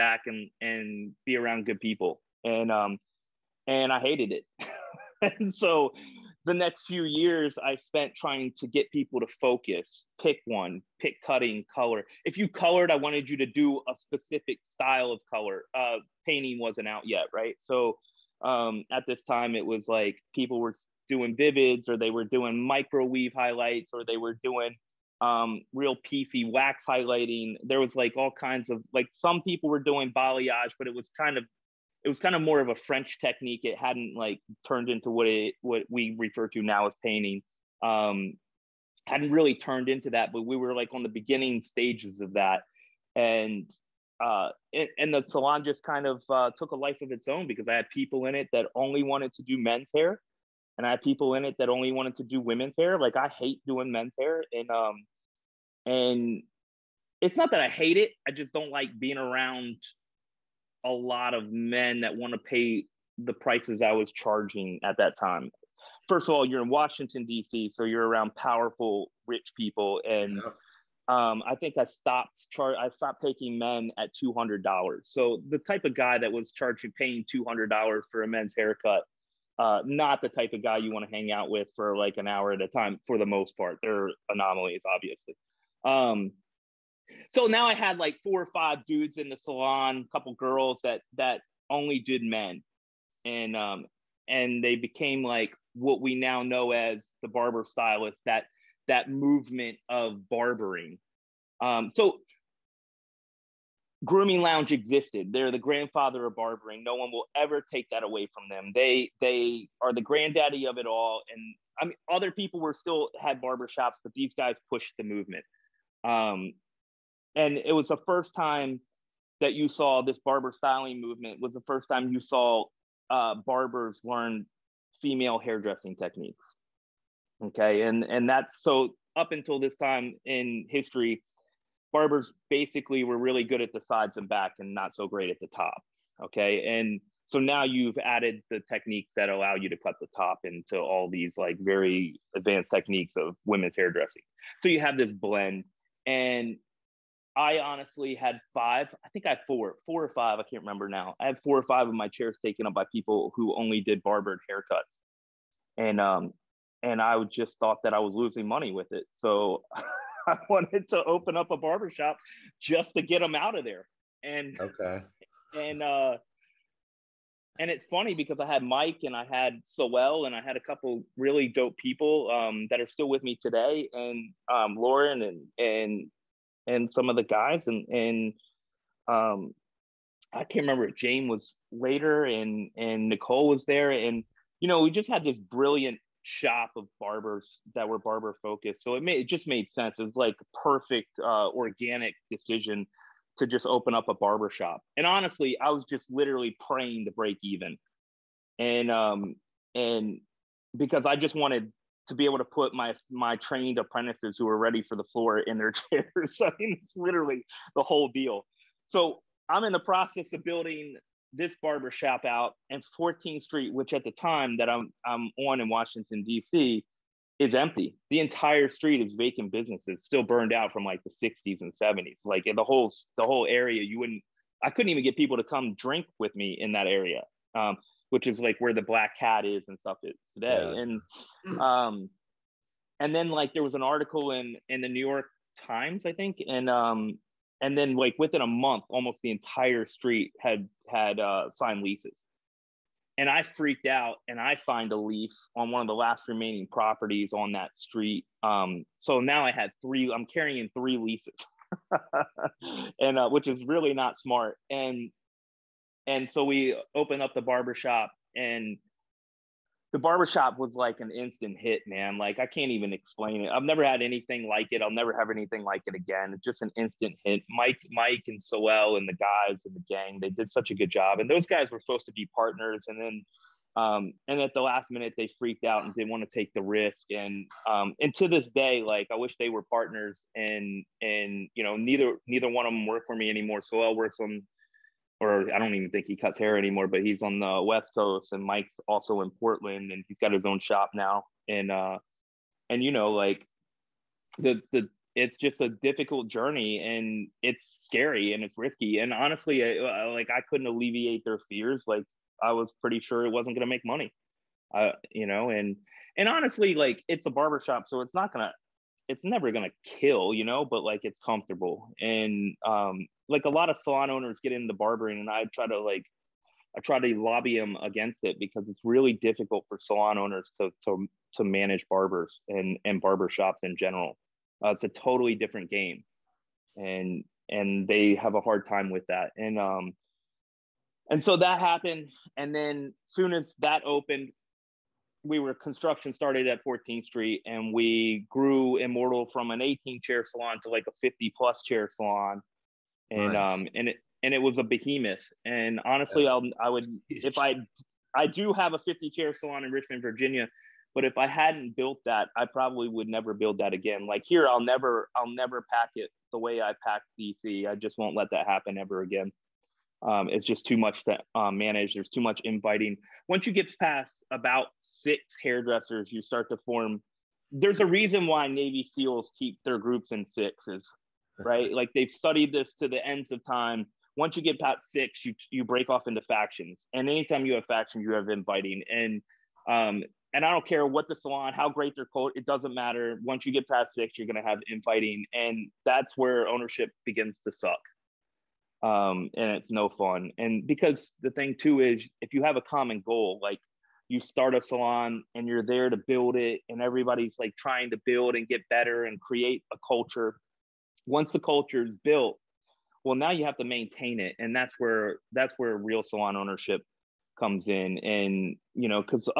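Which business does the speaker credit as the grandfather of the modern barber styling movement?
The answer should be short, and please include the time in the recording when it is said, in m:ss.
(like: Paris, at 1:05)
Grooming Lounge, at 1:44.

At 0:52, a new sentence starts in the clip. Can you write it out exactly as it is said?
Like I hate doing men's hair, and um, and it's not that I hate it.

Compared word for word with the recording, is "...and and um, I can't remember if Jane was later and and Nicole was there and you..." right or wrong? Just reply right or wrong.
right.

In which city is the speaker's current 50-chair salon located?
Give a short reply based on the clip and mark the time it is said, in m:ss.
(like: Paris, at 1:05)
Richmond, Virginia, at 5:49.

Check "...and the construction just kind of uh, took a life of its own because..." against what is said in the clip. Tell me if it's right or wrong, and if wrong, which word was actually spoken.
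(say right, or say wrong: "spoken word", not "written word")
wrong: "salon", not "construction".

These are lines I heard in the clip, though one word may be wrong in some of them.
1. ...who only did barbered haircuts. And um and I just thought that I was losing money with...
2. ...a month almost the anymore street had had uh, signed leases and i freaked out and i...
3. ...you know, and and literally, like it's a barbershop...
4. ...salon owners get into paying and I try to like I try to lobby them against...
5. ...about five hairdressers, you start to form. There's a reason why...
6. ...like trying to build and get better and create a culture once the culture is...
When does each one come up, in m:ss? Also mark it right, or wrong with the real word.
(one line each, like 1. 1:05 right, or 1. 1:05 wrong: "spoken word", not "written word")
1. 2:33 right
2. 3:58 wrong: "entire", not "anymore"
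3. 5:05 wrong: "honestly", not "literally"
4. 5:13 wrong: "barbering", not "paying"
5. 6:04 wrong: "six", not "five"
6. 6:37 right.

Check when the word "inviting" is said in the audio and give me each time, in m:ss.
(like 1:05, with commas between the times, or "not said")
6:02, 6:18.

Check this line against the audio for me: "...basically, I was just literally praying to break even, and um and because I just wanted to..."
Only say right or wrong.
wrong.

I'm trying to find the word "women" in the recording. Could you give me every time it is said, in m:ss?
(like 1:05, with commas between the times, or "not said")
0:52, 2:23.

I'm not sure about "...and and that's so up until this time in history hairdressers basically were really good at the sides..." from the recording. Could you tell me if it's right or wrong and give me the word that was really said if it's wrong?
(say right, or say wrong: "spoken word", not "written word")
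wrong: "barbers", not "hairdressers".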